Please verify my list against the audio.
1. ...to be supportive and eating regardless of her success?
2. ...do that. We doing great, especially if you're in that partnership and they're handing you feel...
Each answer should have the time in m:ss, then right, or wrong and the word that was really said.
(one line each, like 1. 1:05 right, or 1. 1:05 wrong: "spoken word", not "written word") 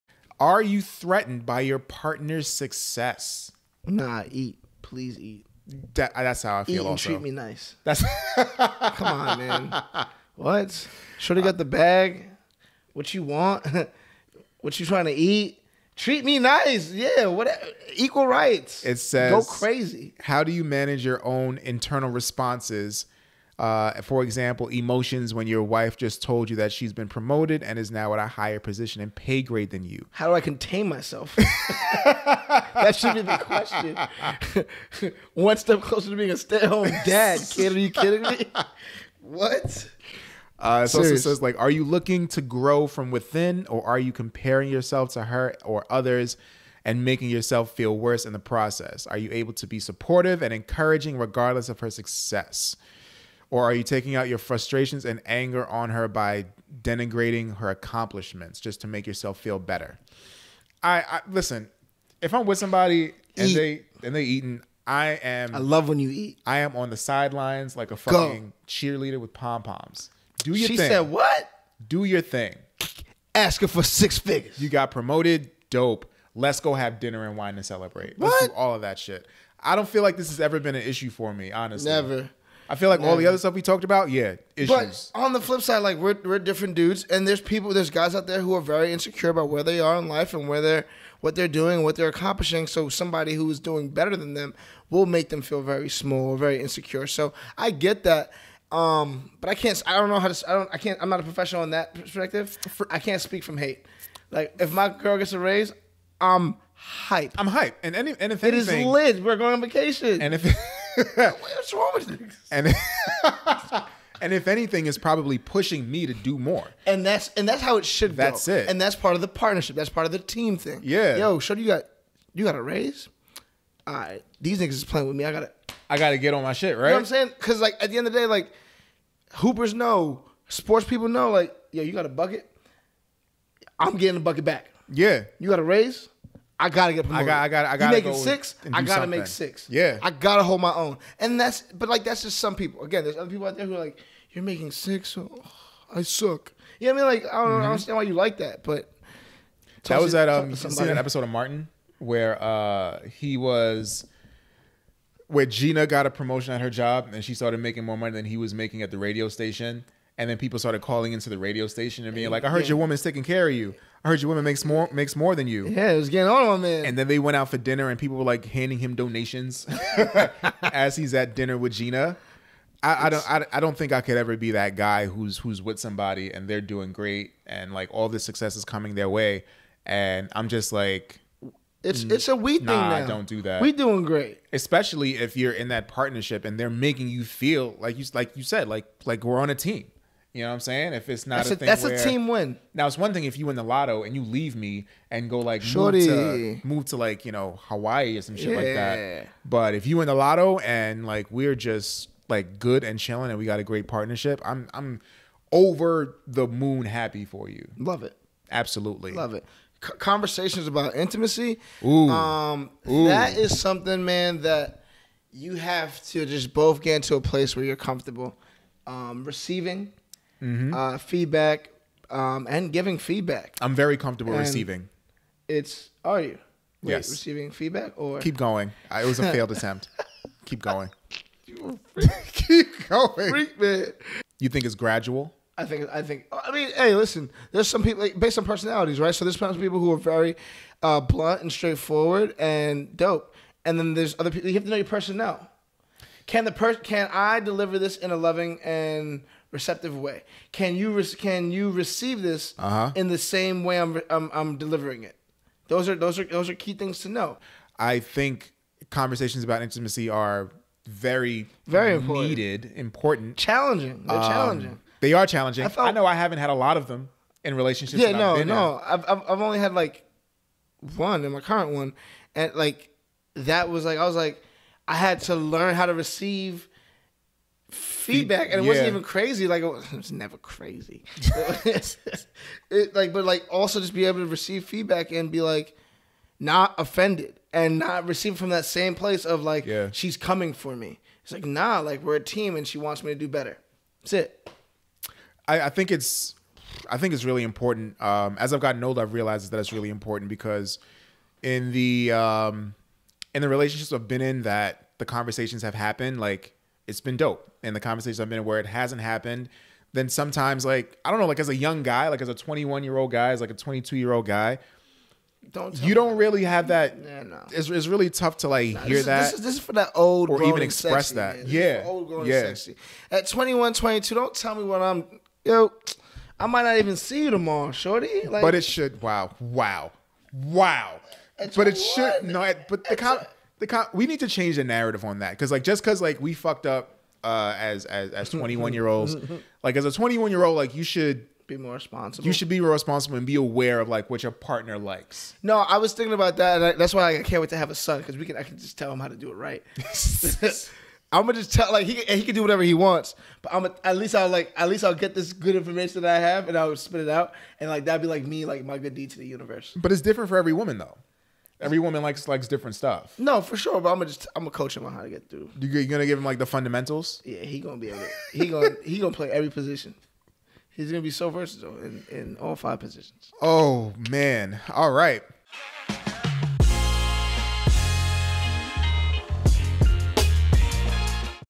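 1. 0:49 wrong: "encouraging", not "eating"
2. 3:03 wrong: "making", not "handing".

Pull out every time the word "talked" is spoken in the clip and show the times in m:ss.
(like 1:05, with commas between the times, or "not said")
1:23.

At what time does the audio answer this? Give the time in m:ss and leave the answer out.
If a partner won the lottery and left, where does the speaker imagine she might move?
3:17.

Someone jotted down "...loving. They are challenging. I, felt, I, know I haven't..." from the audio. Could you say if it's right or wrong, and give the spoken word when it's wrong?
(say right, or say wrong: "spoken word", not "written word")
wrong: "challenging", not "loving".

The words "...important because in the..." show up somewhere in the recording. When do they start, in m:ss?
4:59.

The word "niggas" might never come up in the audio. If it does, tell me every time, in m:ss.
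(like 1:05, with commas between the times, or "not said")
1:52, 2:04.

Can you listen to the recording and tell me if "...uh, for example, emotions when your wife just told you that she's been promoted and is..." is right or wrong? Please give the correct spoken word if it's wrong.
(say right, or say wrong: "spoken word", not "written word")
right.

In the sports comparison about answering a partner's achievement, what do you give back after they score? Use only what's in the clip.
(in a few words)
the bucket.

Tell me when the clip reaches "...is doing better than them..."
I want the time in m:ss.
1:33.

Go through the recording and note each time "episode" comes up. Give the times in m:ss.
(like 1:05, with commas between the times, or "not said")
2:30.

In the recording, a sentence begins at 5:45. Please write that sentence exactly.
No, I was thinking about that.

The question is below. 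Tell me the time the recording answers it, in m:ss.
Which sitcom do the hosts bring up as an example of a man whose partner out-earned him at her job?
2:31.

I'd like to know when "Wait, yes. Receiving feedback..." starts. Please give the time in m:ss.
3:46.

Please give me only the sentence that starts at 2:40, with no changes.
And then people started calling into the radio station and being like, I heard yeah.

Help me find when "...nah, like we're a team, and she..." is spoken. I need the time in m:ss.
4:51.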